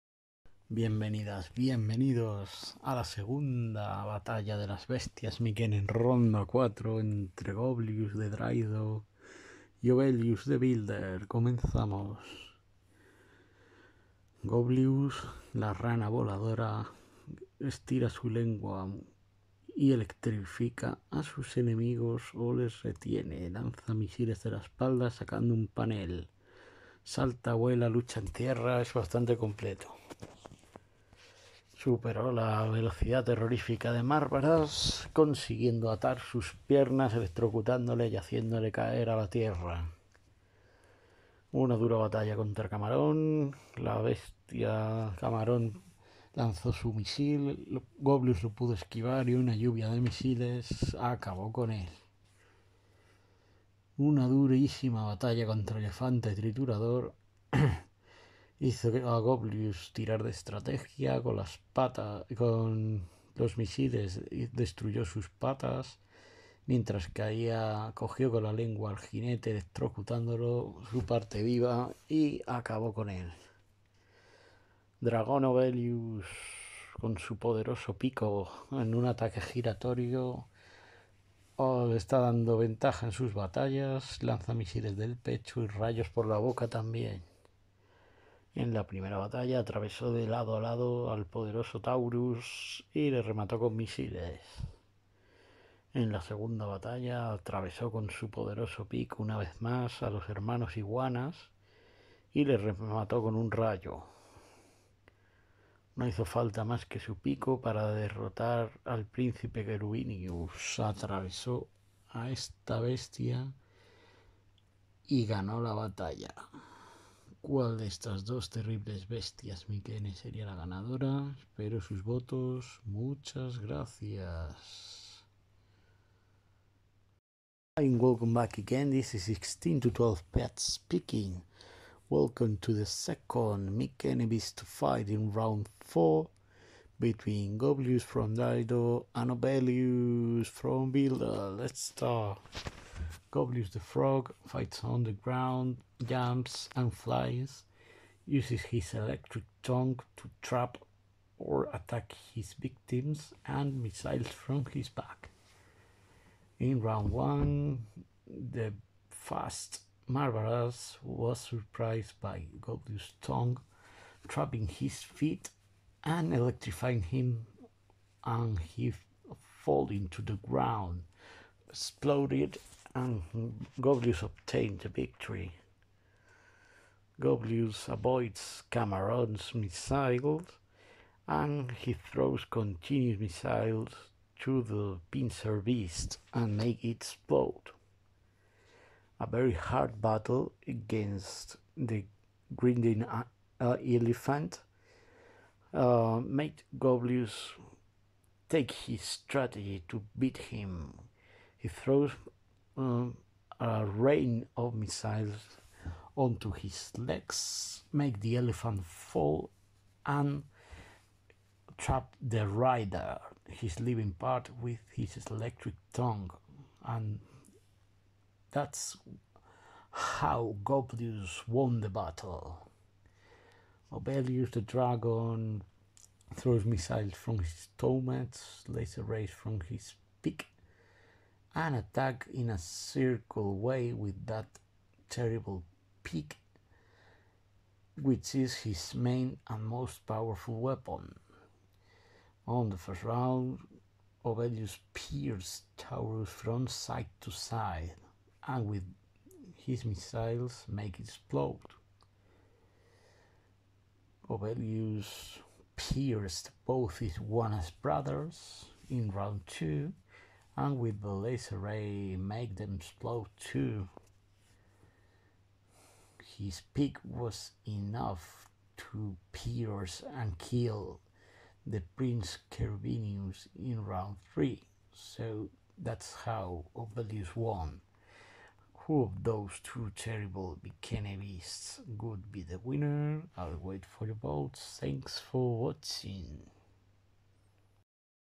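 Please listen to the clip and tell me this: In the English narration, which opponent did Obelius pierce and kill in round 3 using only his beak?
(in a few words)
Prince Cervinius.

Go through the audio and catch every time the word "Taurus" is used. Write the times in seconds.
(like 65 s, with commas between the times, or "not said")
91 s, 245 s.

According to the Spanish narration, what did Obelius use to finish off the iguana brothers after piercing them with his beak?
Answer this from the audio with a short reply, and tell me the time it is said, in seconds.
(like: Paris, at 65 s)
un rayo, at 103 s.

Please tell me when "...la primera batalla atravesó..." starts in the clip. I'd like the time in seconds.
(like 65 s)
88 s.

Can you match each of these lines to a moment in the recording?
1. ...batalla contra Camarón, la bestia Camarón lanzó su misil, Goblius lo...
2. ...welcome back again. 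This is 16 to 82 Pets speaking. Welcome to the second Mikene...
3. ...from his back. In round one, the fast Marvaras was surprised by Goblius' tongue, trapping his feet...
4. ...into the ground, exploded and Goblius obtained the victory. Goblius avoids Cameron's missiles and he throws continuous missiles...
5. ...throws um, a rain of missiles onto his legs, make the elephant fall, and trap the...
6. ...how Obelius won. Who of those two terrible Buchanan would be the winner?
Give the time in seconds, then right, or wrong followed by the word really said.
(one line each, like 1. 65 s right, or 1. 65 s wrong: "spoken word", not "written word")
1. 41 s right
2. 128 s wrong: "12", not "82"
3. 154 s right
4. 169 s right
5. 201 s right
6. 276 s right.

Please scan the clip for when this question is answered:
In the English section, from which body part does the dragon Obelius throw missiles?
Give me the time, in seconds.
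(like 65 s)
227 s.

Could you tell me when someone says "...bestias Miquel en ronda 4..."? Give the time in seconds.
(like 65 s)
4 s.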